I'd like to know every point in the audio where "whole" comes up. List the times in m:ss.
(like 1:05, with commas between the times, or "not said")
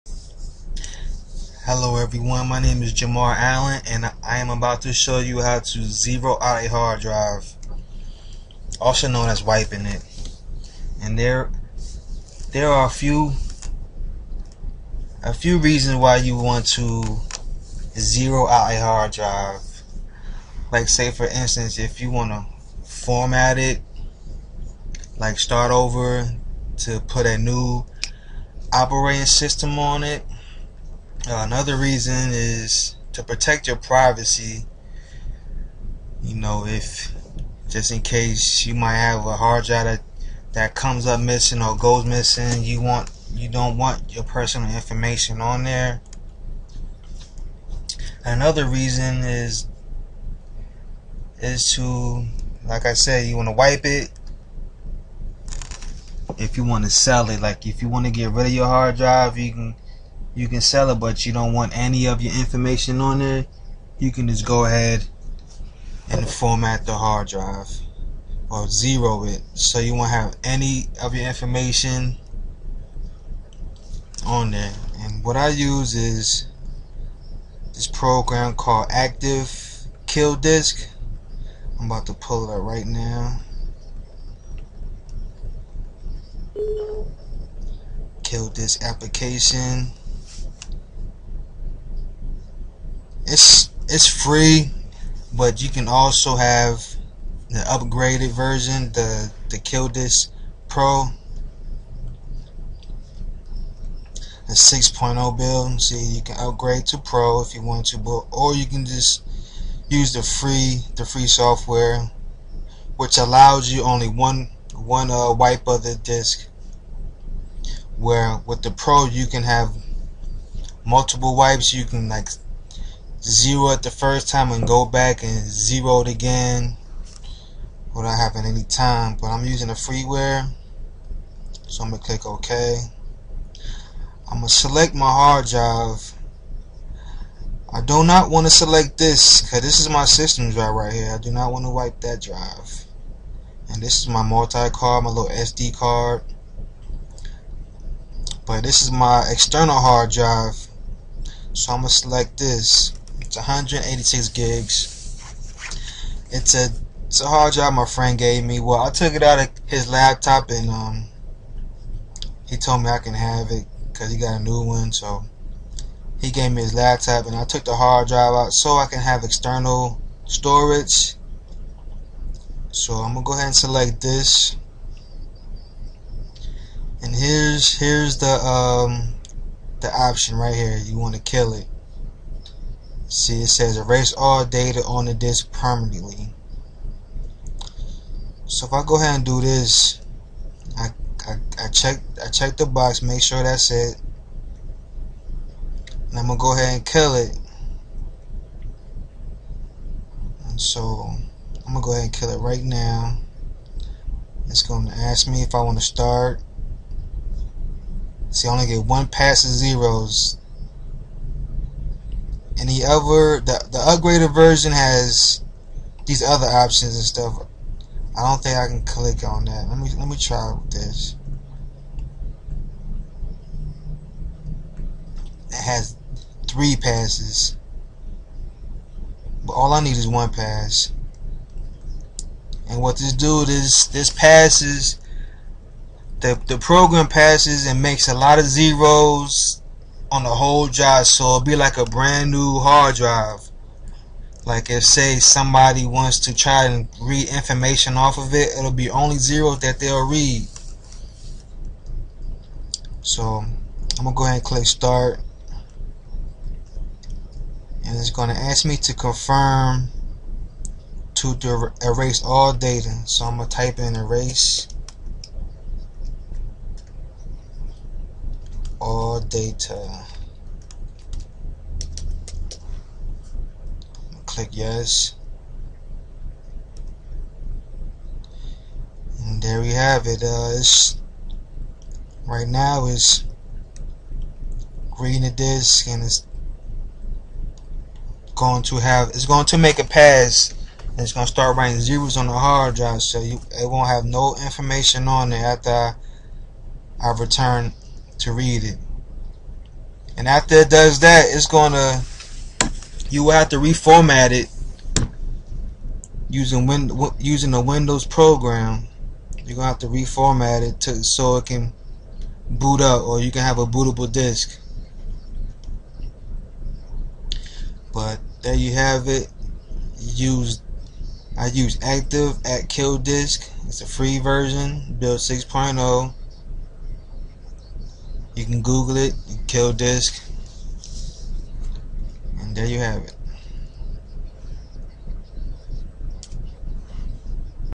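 4:00.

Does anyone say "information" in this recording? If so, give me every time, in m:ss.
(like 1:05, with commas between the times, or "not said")
0:44, 1:02, 1:11, 4:07, 4:54.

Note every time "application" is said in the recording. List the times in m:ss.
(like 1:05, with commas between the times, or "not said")
1:28.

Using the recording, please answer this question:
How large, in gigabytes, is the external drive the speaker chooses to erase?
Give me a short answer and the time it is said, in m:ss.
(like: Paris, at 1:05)
186, at 2:33.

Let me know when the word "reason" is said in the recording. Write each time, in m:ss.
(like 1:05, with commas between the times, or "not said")
0:15, 0:31, 0:48.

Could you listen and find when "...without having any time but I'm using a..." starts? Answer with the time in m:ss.
2:07.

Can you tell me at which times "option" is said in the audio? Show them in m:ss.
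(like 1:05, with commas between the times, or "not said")
2:59, 3:36.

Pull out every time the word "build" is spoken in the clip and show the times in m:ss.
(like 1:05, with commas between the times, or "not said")
1:45, 5:24.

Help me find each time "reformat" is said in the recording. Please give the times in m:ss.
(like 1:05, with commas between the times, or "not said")
5:03, 5:09.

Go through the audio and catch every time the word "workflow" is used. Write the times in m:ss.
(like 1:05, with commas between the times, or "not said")
not said.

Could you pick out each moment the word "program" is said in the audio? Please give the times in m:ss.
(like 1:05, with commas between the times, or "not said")
1:17, 3:56, 5:08.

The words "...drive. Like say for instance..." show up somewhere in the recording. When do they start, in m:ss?
0:19.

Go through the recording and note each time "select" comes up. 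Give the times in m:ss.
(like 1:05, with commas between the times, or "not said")
2:14, 2:18, 2:31, 2:53.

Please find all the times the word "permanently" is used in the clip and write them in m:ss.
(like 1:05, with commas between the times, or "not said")
3:05.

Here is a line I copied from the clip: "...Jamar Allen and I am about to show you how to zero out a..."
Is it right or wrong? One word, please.
right.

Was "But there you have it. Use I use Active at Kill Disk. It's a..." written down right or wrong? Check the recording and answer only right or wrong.
right.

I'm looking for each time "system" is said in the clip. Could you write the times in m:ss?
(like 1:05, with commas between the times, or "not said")
0:29, 2:20.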